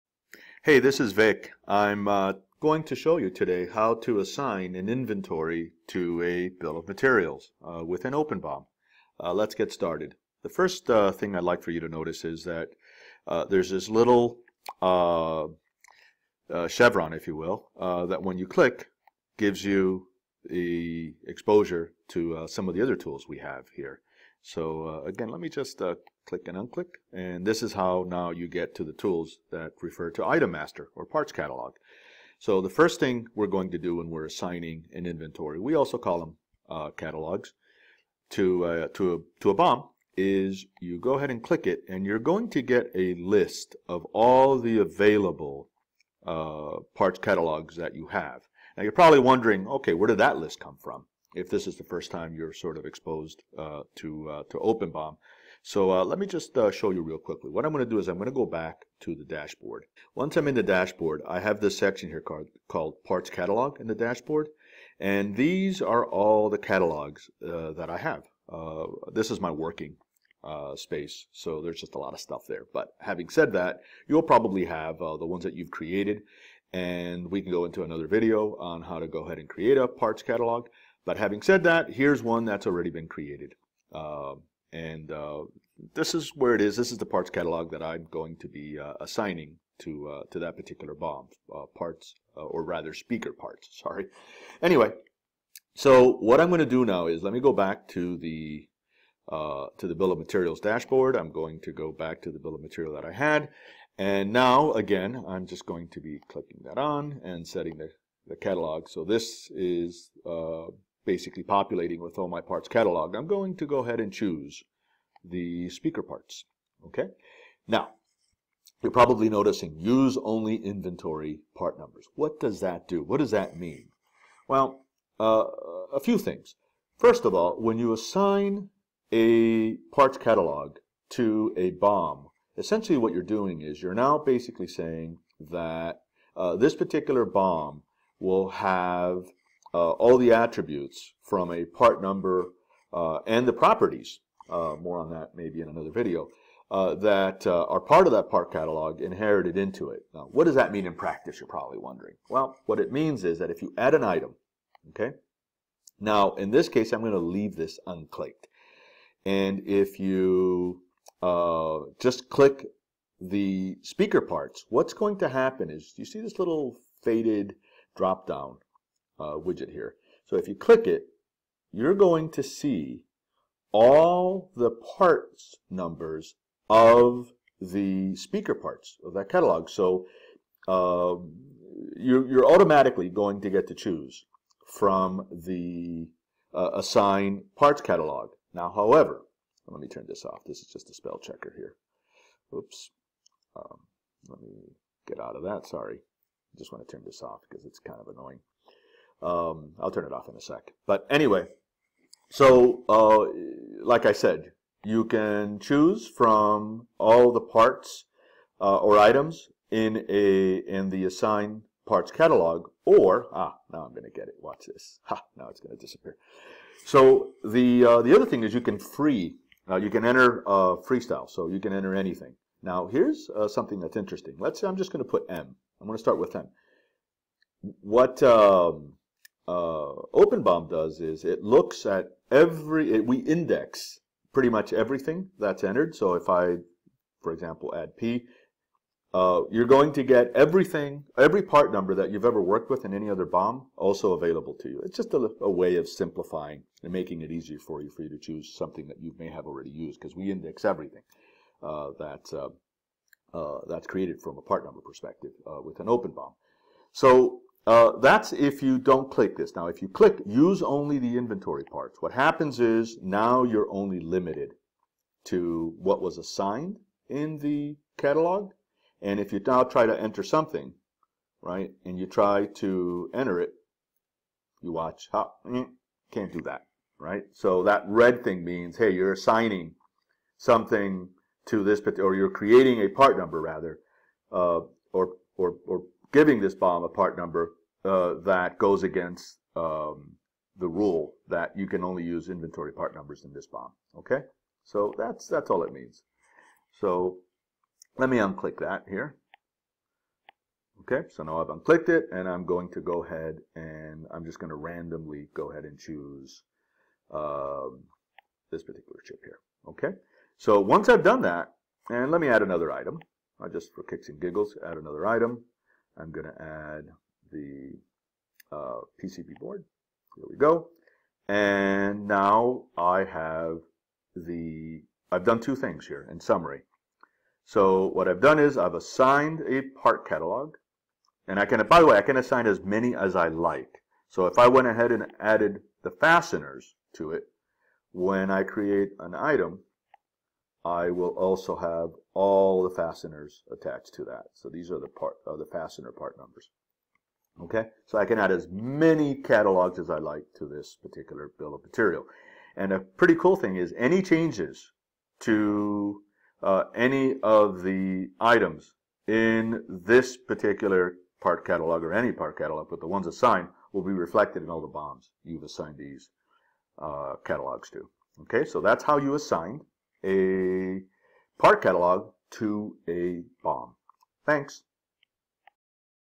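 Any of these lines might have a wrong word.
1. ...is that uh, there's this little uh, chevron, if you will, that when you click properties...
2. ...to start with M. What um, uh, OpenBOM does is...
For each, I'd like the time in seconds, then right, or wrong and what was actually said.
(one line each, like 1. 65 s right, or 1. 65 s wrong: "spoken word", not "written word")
1. 12 s wrong: "gives", not "properties"
2. 225 s right.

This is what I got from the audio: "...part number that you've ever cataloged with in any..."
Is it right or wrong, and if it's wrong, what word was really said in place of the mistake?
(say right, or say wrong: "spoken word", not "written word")
wrong: "worked", not "cataloged".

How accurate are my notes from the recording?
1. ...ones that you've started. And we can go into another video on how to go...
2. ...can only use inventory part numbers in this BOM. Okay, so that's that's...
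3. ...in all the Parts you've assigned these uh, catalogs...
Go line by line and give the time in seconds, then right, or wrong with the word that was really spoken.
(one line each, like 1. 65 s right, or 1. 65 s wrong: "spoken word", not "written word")
1. 75 s wrong: "created", not "started"
2. 291 s right
3. 364 s wrong: "BOMs", not "Parts".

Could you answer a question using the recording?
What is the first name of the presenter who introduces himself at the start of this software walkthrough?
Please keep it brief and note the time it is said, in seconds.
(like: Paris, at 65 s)
Vic, at 1 s.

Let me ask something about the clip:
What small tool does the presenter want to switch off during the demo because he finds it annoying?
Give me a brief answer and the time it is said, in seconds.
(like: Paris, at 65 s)
spell checker, at 190 s.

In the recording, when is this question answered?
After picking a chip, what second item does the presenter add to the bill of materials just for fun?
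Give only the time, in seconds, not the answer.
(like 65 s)
319 s.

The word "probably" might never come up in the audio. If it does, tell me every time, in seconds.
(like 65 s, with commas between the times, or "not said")
48 s, 74 s, 118 s, 151 s.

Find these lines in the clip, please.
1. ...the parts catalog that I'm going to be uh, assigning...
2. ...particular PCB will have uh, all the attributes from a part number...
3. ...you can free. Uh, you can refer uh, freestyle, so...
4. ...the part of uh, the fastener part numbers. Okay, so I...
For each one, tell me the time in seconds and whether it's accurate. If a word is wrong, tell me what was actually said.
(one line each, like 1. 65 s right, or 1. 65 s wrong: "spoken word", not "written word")
1. 86 s right
2. 136 s wrong: "BOM", not "PCB"
3. 218 s wrong: "enter", not "refer"
4. 344 s right.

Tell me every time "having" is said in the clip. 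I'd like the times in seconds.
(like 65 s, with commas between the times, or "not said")
72 s, 81 s.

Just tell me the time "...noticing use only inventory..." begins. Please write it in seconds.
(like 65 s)
119 s.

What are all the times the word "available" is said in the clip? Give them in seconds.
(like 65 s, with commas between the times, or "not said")
44 s, 244 s.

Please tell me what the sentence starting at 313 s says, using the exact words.
I just for kicks and giggles add another item.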